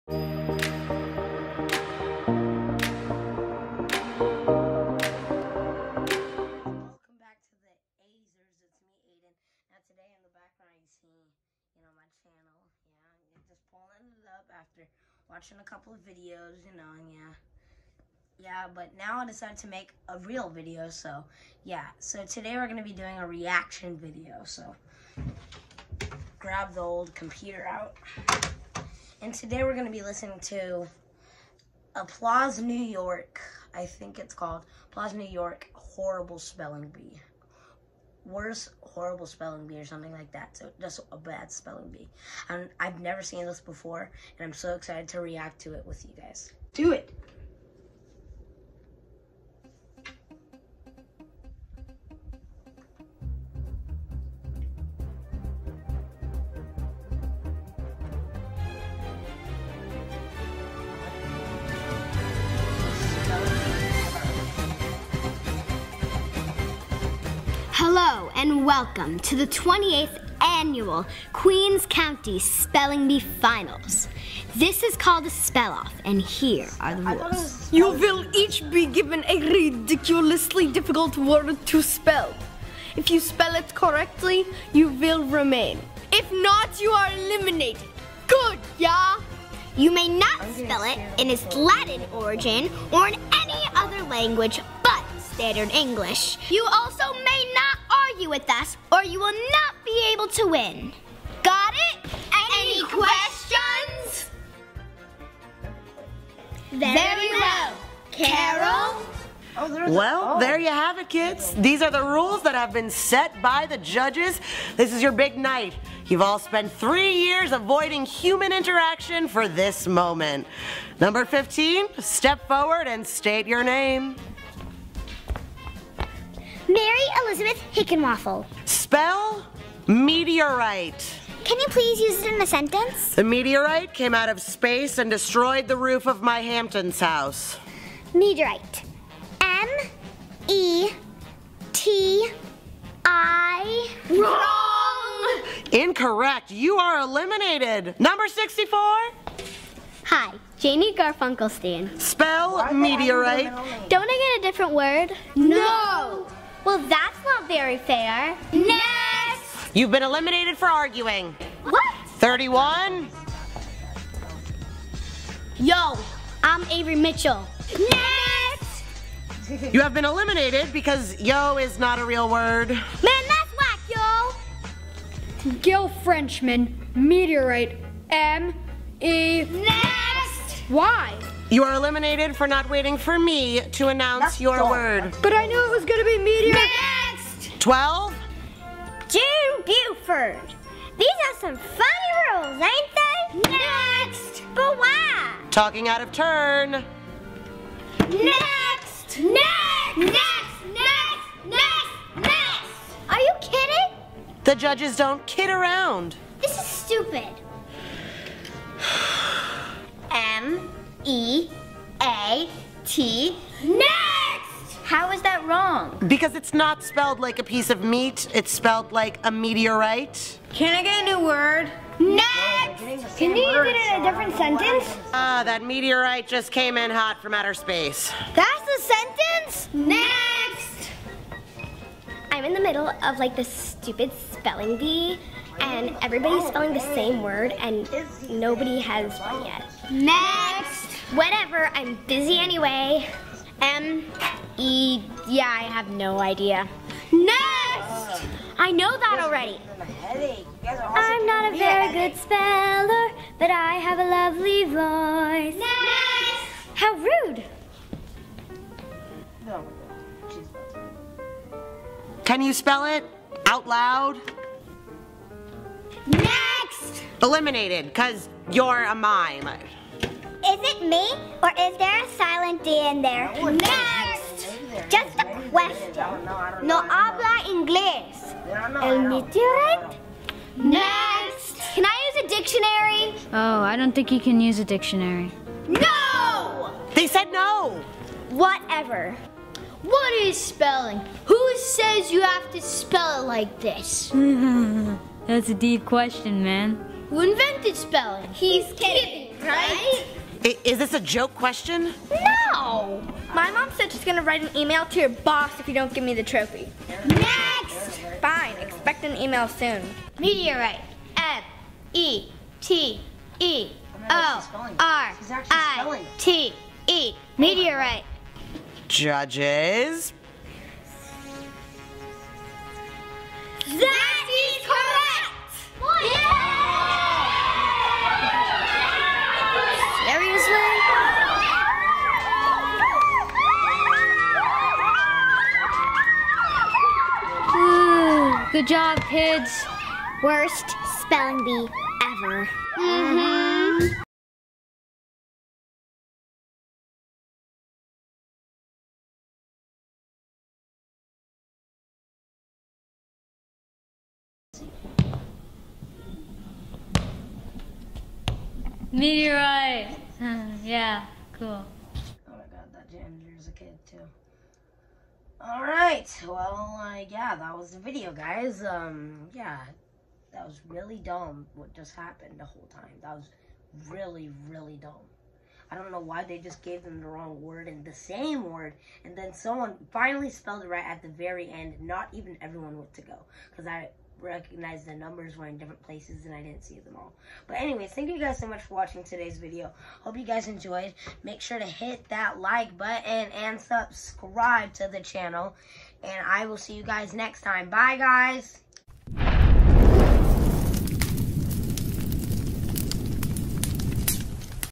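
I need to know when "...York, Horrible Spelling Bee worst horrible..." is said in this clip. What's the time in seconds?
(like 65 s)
35 s.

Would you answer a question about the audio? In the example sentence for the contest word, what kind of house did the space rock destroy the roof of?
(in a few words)
Hamptons house.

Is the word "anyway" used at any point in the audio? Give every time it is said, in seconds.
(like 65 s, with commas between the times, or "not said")
242 s, 387 s.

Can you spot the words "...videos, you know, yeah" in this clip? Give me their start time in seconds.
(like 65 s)
15 s.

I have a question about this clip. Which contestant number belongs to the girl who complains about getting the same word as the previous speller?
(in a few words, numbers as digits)
64.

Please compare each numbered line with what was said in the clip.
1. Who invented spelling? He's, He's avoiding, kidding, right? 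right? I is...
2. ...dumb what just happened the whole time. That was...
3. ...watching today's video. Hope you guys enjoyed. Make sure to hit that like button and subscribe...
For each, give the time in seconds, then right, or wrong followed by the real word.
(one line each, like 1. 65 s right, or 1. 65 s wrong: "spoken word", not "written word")
1. 297 s wrong: "kidding", not "avoiding"
2. 370 s right
3. 388 s right.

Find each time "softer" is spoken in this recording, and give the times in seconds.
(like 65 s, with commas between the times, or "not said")
not said.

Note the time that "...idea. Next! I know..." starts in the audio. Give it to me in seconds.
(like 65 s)
246 s.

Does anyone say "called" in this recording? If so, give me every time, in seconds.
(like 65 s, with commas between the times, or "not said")
34 s, 74 s.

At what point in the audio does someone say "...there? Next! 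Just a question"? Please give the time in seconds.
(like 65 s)
273 s.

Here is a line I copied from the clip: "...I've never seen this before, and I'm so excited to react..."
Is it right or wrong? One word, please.
right.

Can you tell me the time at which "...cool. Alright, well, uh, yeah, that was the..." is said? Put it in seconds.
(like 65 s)
361 s.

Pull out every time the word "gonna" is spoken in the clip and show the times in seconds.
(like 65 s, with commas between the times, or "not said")
22 s, 29 s, 185 s, 304 s.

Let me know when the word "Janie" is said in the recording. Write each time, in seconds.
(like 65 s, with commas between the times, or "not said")
150 s.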